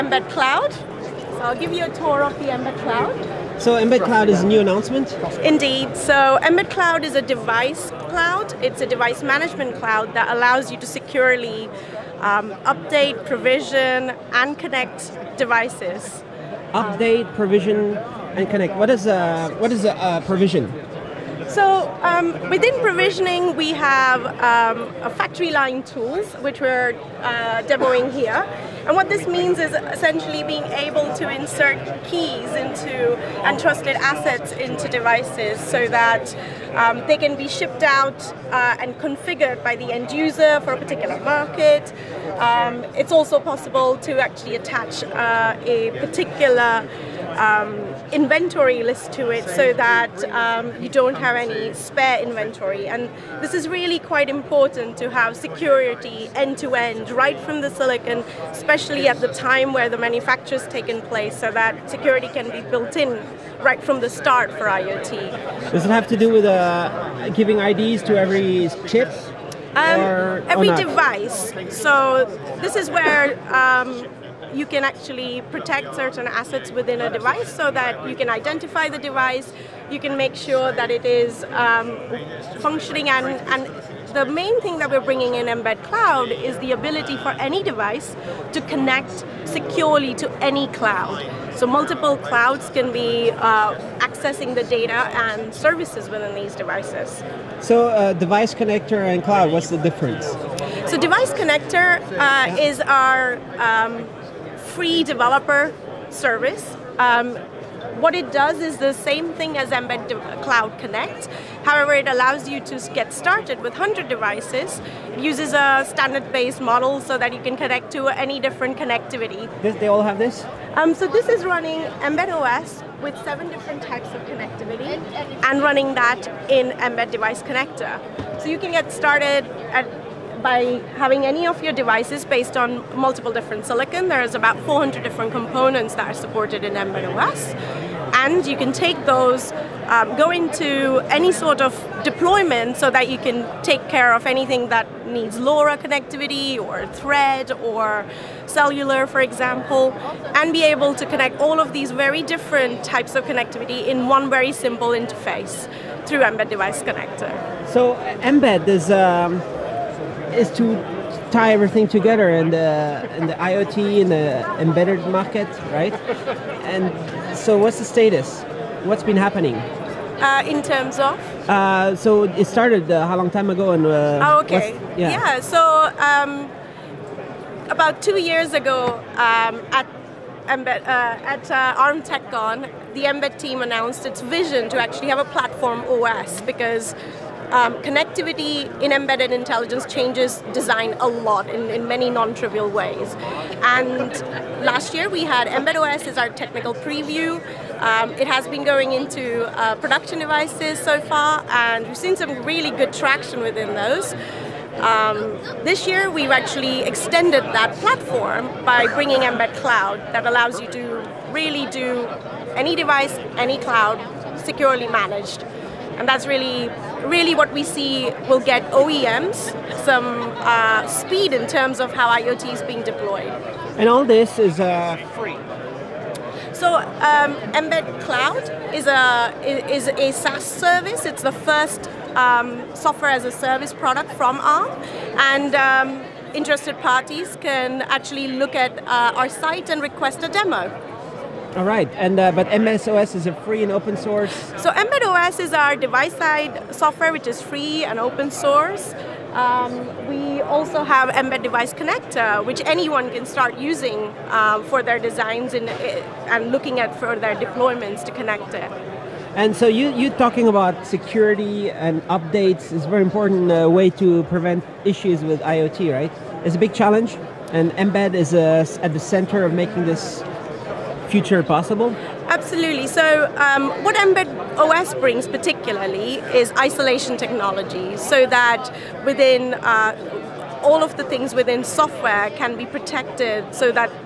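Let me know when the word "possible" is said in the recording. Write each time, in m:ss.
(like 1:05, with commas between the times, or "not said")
0:43, 4:31.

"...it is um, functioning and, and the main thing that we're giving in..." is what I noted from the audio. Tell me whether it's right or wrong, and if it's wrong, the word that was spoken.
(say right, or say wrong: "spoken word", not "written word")
wrong: "bringing", not "giving".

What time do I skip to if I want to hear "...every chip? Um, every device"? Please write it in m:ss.
1:08.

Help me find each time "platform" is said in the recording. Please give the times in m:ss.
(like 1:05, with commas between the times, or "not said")
3:05, 3:27.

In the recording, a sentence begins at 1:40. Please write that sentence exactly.
So device connector uh, is our um, free developer service.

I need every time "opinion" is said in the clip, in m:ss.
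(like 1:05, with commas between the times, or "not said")
not said.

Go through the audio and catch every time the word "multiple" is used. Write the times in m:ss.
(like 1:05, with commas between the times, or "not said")
1:31, 2:12.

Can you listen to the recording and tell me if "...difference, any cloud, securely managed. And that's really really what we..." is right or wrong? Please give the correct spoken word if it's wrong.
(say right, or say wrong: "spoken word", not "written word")
wrong: "device", not "difference".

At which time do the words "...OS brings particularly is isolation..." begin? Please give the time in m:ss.
4:34.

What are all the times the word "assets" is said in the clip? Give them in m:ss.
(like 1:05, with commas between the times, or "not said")
0:33, 1:16.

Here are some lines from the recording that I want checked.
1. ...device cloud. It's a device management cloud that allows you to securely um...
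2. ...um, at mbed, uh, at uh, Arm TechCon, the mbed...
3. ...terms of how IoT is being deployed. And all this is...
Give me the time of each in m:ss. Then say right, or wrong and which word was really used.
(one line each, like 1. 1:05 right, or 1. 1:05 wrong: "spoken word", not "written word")
1. 0:07 right
2. 2:59 right
3. 3:41 right.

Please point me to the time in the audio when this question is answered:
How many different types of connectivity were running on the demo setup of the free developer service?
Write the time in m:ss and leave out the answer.
2:03.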